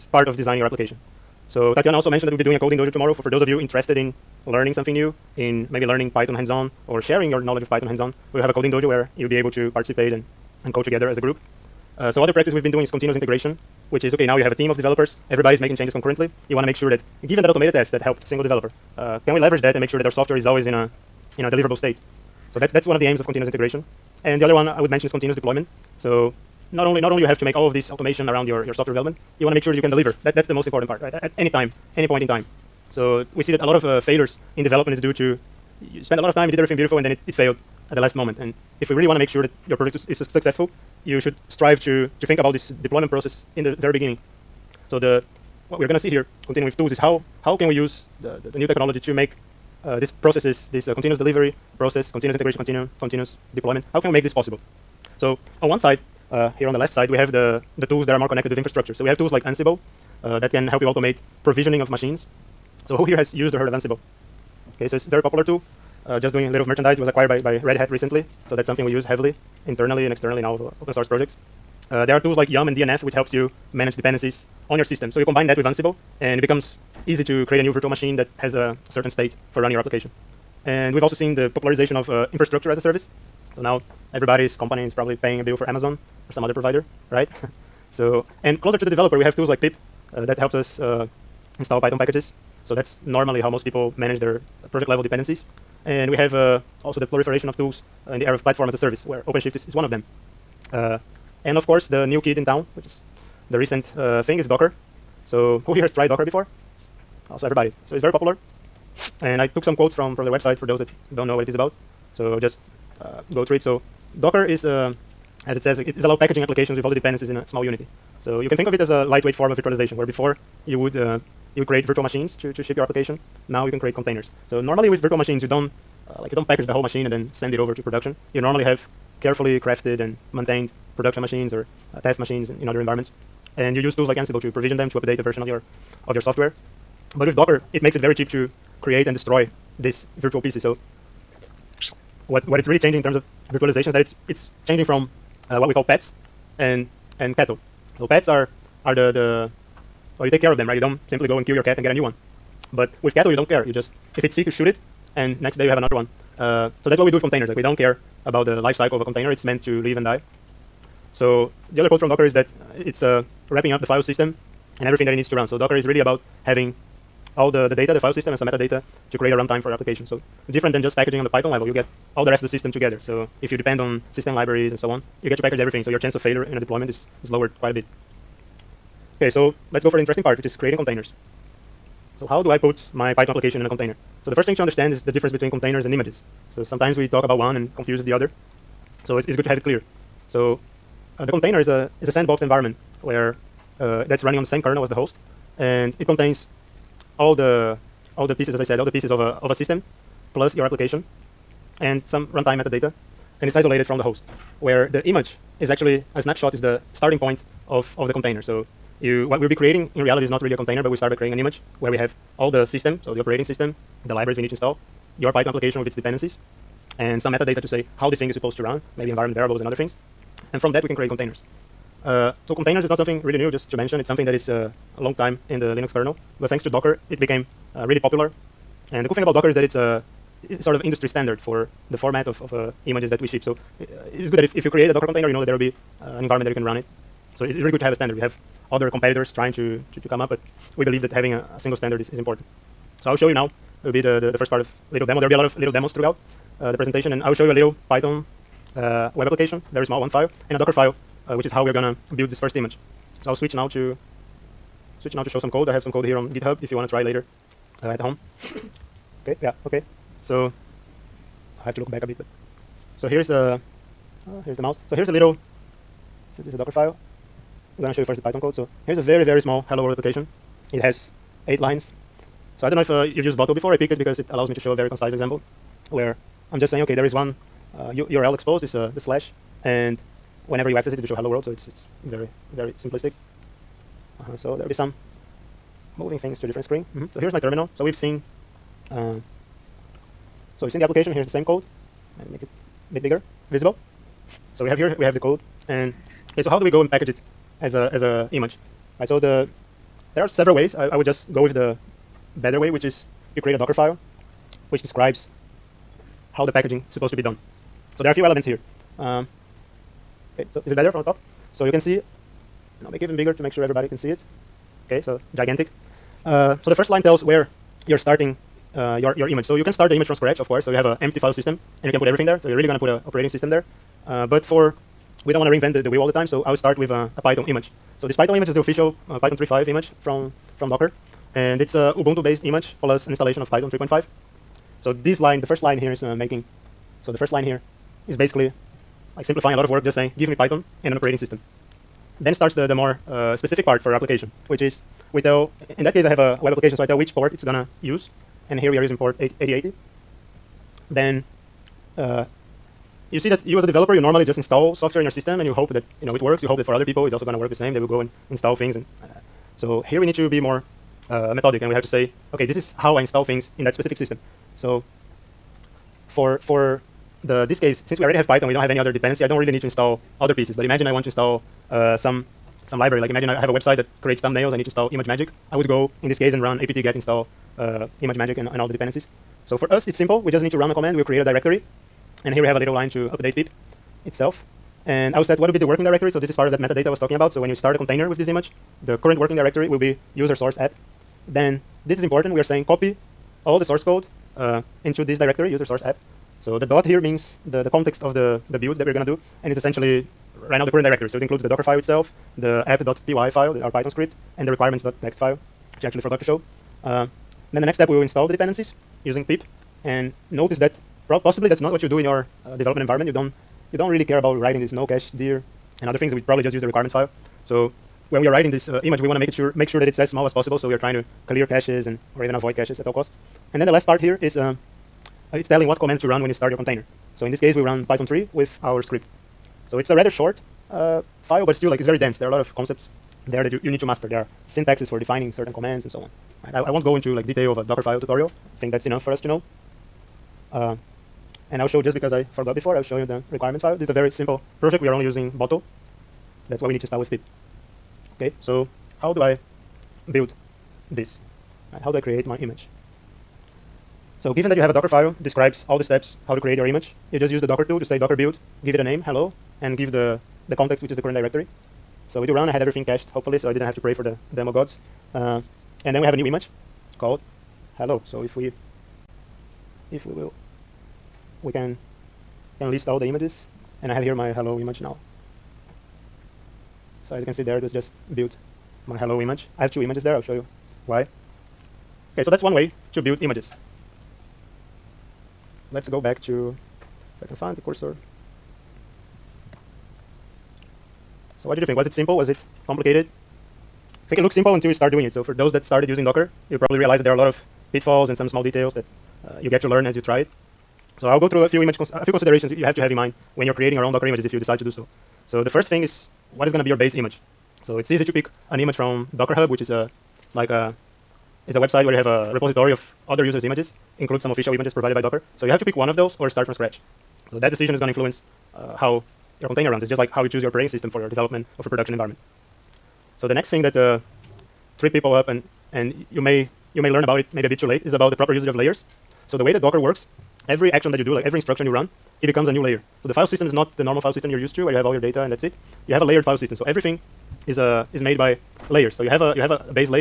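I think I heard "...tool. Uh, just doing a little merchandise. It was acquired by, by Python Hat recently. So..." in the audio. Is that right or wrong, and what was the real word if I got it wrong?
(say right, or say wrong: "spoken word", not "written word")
wrong: "Red", not "Python".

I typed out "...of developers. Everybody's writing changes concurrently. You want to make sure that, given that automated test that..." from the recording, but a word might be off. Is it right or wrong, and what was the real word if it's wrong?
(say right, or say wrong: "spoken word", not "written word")
wrong: "making", not "writing".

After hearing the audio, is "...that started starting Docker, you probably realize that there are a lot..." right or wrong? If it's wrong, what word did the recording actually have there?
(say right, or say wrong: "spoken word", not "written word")
wrong: "using", not "starting".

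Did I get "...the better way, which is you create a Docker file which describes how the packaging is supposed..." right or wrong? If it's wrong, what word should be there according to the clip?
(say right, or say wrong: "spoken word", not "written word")
right.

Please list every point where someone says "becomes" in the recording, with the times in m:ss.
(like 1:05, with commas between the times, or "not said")
1:16, 8:52.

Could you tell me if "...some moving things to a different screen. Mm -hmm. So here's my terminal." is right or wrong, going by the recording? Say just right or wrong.
right.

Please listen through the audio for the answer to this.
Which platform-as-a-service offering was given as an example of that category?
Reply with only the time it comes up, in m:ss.
1:39.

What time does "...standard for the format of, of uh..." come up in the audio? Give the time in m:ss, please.
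3:51.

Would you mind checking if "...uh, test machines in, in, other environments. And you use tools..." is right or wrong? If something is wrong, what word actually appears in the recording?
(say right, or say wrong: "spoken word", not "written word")
right.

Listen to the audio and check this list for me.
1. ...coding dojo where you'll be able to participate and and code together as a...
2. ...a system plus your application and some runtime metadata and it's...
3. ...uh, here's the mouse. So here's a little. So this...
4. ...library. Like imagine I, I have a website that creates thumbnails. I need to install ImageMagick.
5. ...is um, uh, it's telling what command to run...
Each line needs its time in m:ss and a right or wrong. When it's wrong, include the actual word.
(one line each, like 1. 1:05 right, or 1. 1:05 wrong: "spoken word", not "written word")
1. 0:08 right
2. 3:19 right
3. 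4:24 right
4. 6:12 right
5. 7:04 right.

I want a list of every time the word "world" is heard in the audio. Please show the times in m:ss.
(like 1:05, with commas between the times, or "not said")
4:29, 4:41.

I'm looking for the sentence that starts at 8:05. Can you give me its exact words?
Let's go back to, if I can find the cursor.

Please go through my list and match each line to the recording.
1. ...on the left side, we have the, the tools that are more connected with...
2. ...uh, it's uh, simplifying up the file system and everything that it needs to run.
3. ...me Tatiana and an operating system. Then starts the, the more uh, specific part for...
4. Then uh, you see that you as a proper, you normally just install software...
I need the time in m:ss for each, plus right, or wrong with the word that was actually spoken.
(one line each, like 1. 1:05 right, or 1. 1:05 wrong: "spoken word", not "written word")
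1. 0:56 right
2. 2:42 wrong: "wrapping", not "simplifying"
3. 5:40 wrong: "Python", not "Tatiana"
4. 5:50 wrong: "developer", not "proper".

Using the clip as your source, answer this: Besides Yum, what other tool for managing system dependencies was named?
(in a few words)
DNF.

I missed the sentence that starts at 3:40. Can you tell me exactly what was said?
And from that, we can create containers.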